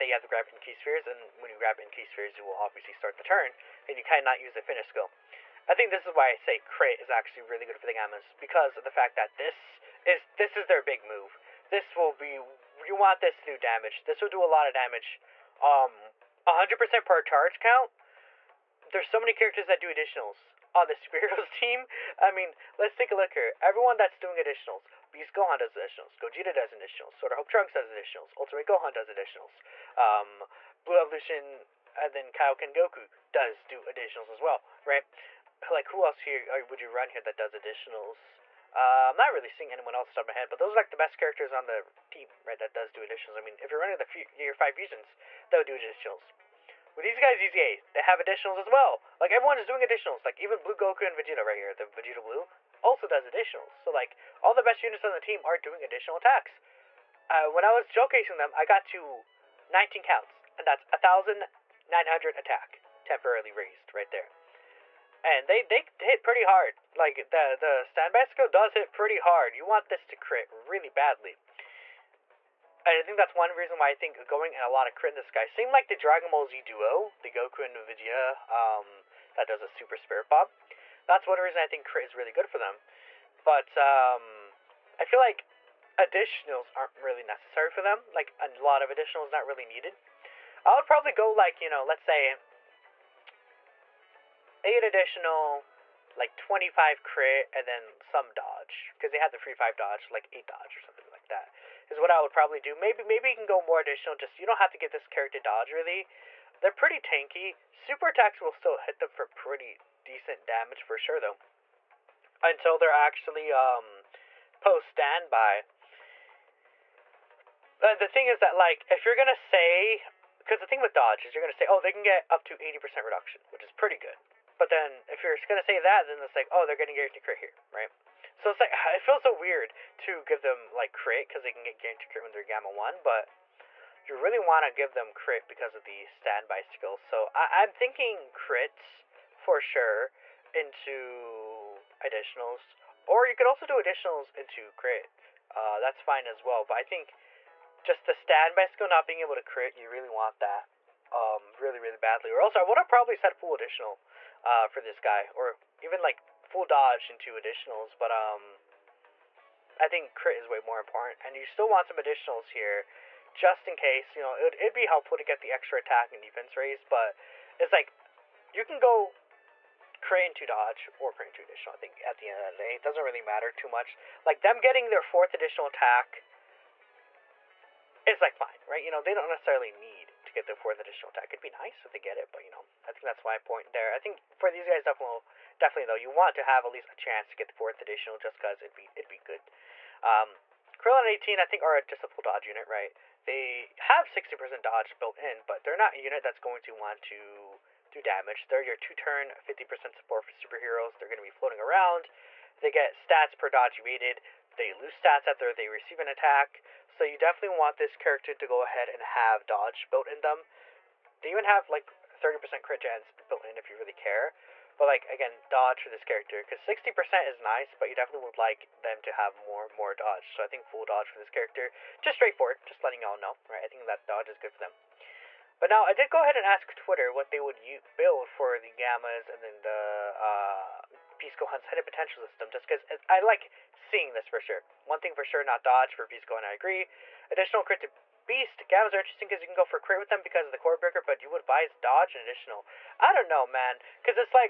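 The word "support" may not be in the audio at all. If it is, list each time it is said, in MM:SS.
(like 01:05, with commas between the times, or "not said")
03:19.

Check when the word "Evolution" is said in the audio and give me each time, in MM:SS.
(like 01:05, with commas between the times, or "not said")
00:30.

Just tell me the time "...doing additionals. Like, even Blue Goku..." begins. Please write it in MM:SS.
00:49.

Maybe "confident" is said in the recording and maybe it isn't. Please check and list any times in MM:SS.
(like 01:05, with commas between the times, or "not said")
not said.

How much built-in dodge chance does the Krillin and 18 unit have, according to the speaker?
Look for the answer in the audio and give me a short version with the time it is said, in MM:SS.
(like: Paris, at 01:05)
60%, at 03:14.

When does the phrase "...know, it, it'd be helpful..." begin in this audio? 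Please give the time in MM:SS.
02:44.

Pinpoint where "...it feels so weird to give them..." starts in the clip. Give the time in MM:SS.
02:08.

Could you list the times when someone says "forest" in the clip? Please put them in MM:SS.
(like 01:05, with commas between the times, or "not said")
not said.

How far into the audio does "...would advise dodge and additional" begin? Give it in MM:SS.
04:01.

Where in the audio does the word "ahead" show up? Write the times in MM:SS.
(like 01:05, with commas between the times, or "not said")
03:28, 03:46.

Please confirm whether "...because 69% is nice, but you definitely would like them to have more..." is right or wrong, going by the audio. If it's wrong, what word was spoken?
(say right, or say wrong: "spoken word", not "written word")
wrong: "60", not "69".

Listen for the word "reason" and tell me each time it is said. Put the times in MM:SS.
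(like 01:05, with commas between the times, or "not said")
01:13, 01:21.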